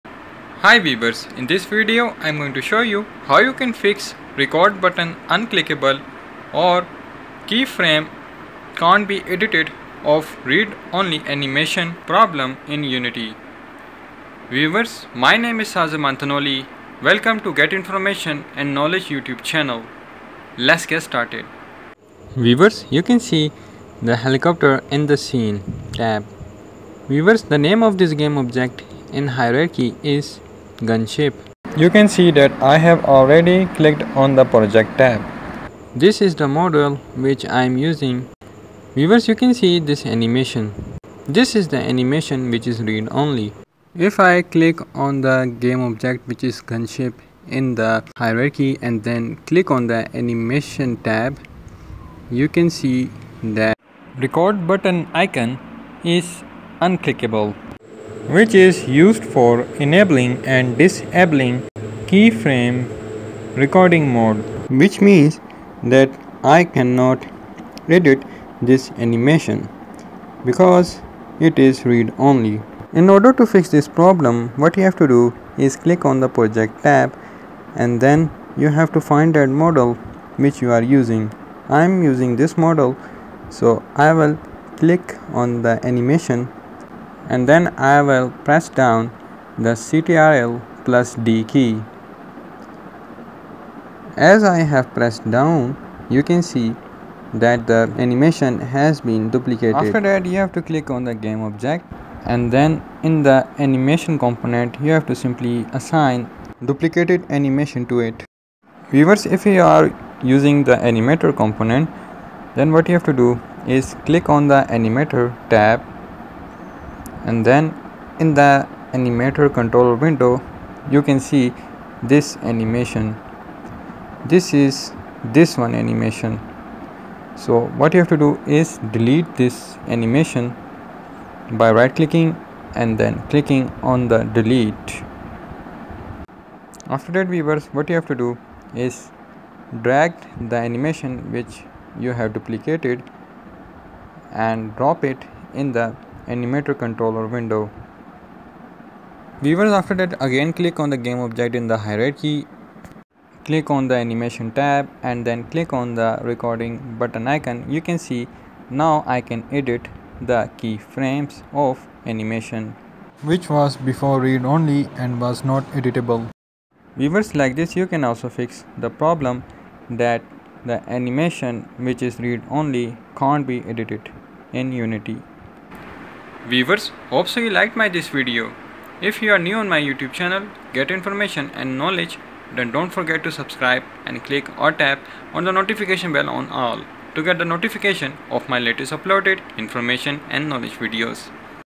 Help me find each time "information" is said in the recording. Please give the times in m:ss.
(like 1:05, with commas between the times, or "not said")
0:17, 3:00, 3:09.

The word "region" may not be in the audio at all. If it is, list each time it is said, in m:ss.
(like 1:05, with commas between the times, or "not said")
not said.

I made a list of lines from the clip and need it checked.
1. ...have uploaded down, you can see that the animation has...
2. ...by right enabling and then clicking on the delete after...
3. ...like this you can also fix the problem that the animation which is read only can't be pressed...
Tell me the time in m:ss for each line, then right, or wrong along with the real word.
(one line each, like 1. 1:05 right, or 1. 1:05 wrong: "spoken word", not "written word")
1. 1:34 wrong: "pressed", not "uploaded"
2. 2:11 wrong: "clicking", not "enabling"
3. 2:47 wrong: "edited", not "pressed".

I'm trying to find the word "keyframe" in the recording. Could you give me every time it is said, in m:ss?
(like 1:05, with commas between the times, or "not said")
0:07, 1:02, 2:40.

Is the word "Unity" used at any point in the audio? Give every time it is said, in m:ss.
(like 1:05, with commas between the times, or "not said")
0:12, 2:54.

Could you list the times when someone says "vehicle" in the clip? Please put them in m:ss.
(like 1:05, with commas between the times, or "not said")
not said.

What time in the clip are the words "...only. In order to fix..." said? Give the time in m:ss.
1:12.